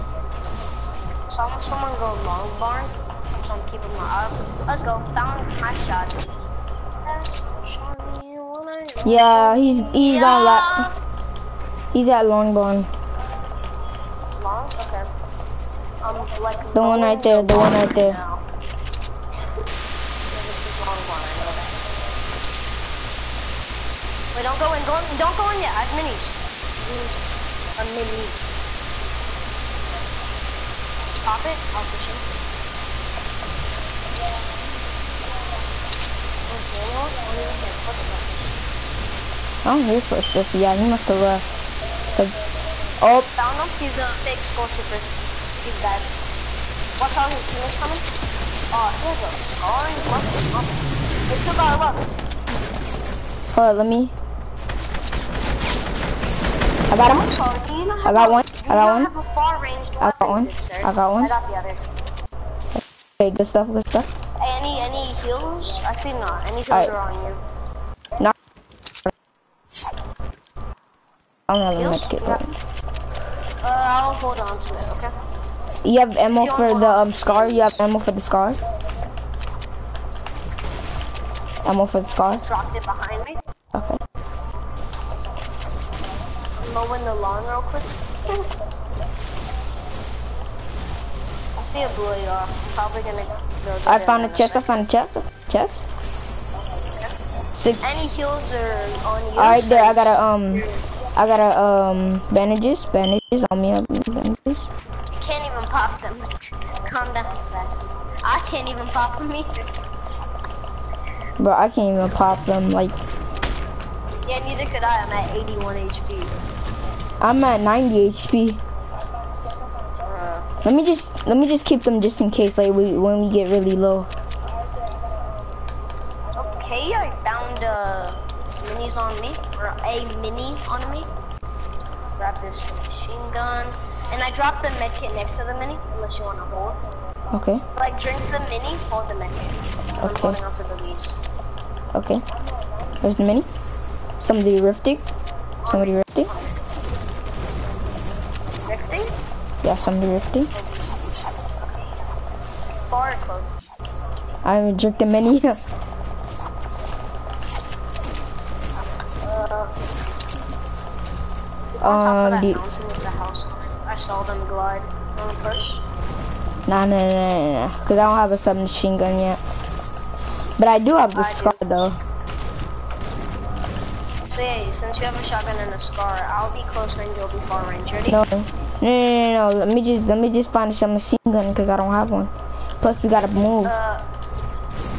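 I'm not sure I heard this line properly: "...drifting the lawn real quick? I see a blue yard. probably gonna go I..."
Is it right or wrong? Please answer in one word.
wrong.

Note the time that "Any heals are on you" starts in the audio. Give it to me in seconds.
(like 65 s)
97 s.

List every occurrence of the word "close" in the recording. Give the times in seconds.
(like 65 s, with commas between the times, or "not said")
153 s, 176 s.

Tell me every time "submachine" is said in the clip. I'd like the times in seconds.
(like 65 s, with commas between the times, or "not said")
168 s.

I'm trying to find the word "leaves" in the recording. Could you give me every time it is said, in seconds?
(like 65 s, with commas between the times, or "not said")
140 s.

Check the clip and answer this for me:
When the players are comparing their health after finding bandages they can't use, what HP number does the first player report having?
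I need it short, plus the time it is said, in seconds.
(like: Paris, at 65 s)
81, at 115 s.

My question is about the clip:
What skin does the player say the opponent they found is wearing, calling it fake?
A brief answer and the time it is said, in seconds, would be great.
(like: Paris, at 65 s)
Skull trooper, at 44 s.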